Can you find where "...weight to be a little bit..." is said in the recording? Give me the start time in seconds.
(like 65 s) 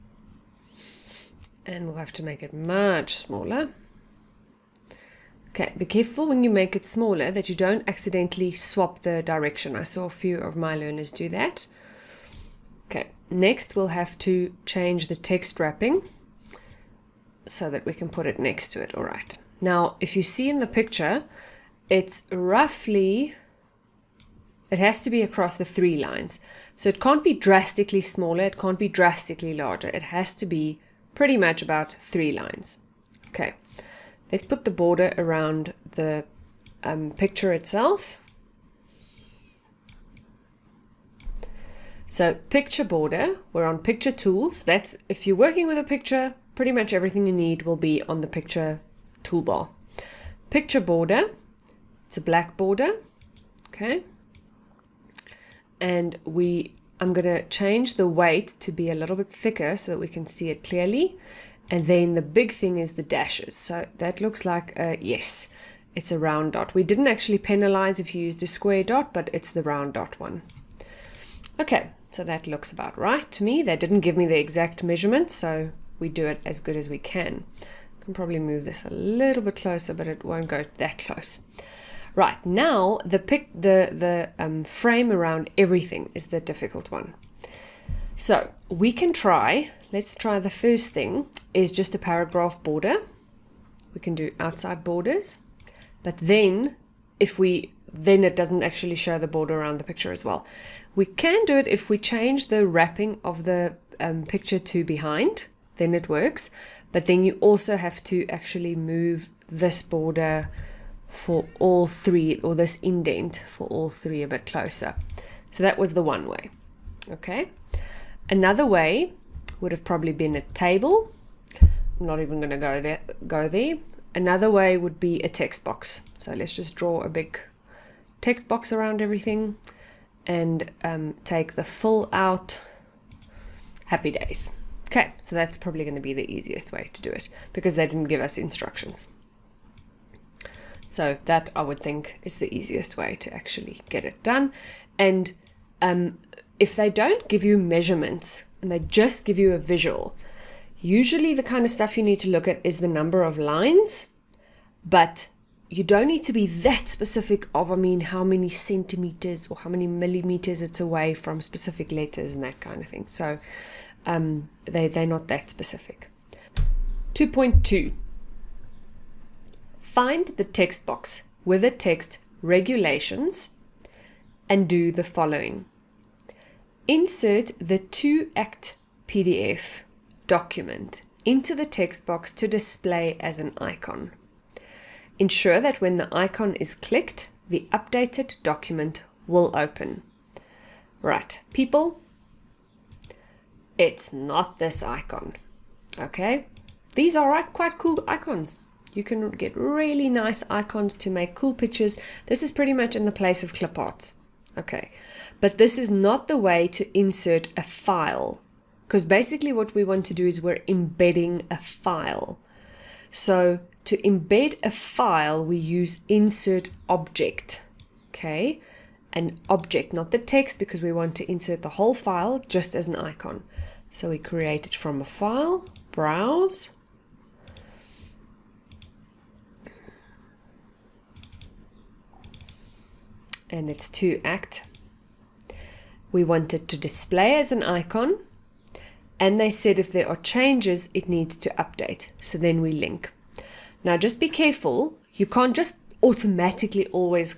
58 s.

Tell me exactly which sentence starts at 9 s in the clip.
I saw a few of my learners do that.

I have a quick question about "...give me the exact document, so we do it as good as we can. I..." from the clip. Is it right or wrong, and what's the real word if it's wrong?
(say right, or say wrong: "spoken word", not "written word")
wrong: "measurement", not "document".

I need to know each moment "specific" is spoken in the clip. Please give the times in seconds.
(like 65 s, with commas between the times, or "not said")
156 s, 161 s, 165 s.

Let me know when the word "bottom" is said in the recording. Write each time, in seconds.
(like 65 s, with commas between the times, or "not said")
not said.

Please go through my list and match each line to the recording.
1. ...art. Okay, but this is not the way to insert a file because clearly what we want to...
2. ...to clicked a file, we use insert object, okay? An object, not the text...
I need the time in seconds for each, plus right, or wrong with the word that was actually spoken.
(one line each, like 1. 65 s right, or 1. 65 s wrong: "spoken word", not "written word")
1. 203 s wrong: "basically", not "clearly"
2. 213 s wrong: "embed", not "clicked".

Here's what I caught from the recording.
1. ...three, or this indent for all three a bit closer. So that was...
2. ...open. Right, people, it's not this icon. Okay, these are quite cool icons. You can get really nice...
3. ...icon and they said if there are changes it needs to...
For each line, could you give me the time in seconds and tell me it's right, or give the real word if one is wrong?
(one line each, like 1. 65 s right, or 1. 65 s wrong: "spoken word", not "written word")
1. 111 s right
2. 189 s right
3. 237 s right.